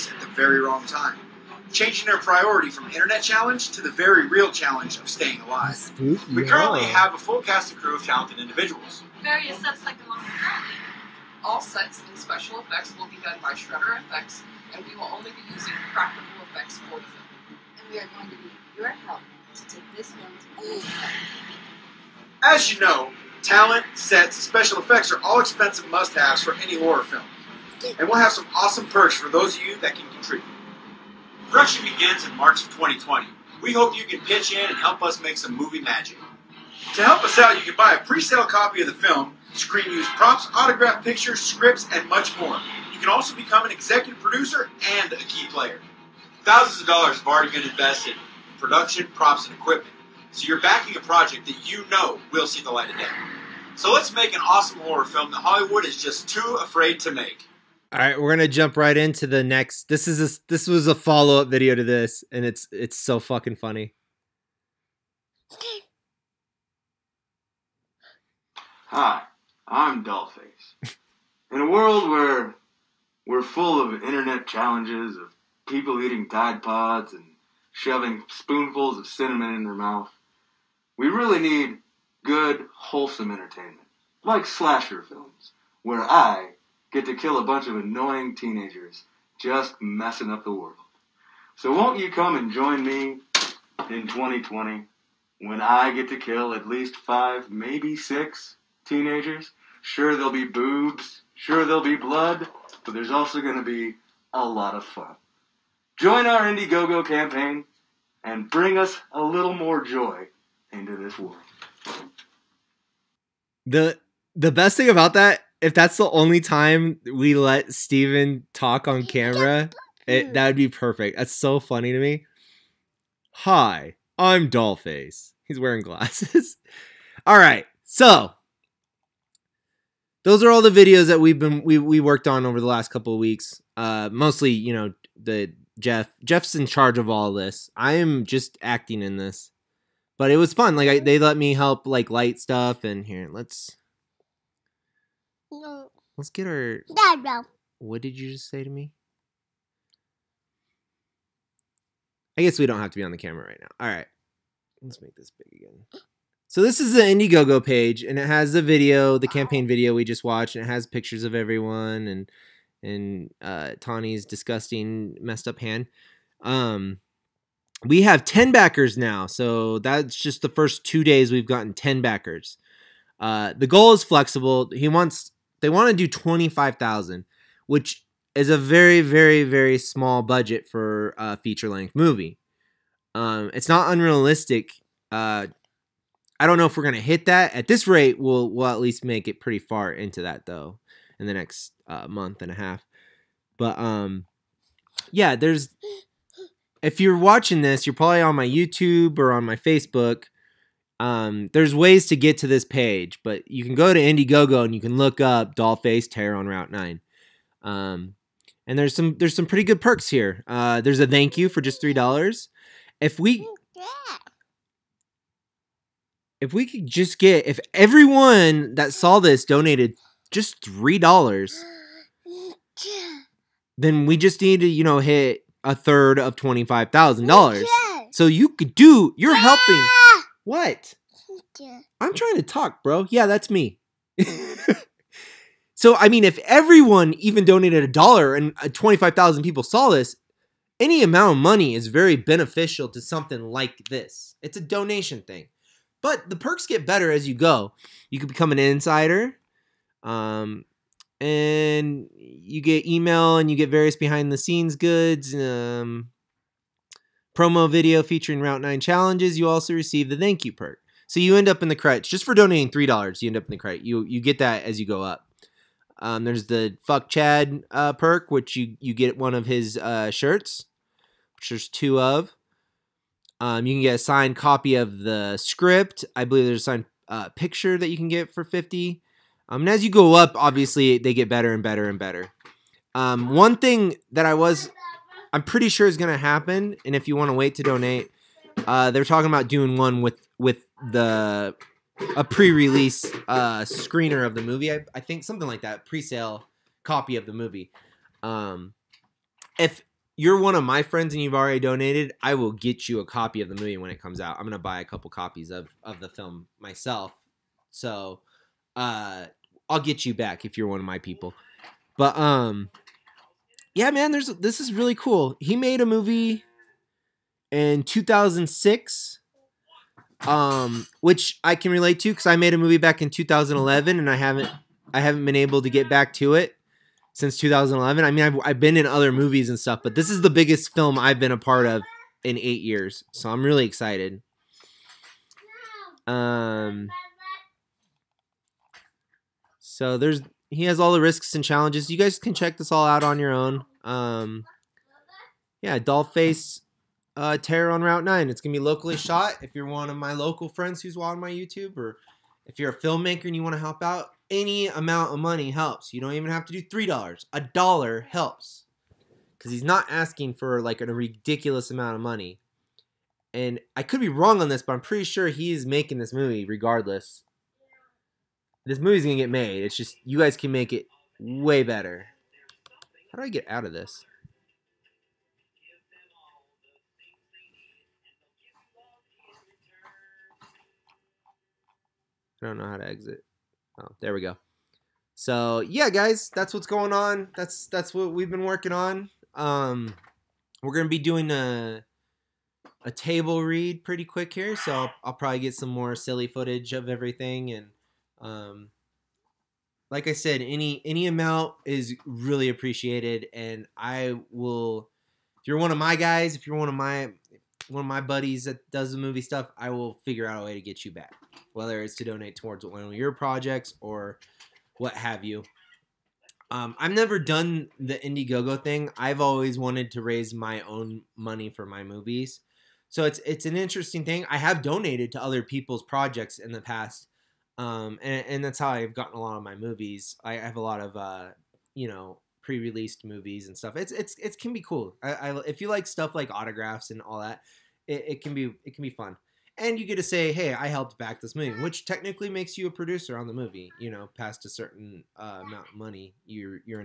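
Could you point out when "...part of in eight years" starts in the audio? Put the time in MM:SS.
05:31.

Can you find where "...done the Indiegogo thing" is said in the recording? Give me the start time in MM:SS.
06:57.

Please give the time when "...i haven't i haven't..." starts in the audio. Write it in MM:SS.
05:24.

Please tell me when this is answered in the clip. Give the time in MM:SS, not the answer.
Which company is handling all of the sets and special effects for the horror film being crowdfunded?
00:13.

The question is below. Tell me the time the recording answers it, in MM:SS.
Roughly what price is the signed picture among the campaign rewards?
04:38.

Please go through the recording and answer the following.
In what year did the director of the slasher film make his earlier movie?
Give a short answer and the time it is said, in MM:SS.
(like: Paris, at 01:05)
2006, at 05:17.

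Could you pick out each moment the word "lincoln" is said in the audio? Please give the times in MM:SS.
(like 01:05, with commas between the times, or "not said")
not said.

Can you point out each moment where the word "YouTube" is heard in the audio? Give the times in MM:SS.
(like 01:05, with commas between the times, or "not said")
03:18, 05:51.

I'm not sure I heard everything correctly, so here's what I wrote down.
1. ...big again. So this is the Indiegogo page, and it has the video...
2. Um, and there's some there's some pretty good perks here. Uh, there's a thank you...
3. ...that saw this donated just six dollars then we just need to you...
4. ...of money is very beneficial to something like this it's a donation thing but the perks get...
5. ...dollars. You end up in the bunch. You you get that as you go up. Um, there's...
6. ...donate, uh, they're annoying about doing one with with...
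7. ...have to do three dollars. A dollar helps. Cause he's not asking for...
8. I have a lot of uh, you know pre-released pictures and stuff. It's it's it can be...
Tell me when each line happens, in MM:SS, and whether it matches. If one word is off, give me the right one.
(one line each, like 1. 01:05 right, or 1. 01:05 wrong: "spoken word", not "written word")
1. 02:35 right
2. 03:27 right
3. 03:38 wrong: "three", not "six"
4. 04:01 right
5. 04:22 wrong: "crutch", not "bunch"
6. 04:47 wrong: "talking", not "annoying"
7. 05:56 right
8. 07:10 wrong: "movies", not "pictures".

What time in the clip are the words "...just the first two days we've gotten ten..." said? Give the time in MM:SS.
02:50.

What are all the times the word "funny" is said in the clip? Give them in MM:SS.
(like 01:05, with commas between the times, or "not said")
01:03, 02:01.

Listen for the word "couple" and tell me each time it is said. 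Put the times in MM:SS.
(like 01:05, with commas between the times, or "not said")
02:12, 05:04.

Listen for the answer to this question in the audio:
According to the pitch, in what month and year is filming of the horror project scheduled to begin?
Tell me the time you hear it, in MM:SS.
00:32.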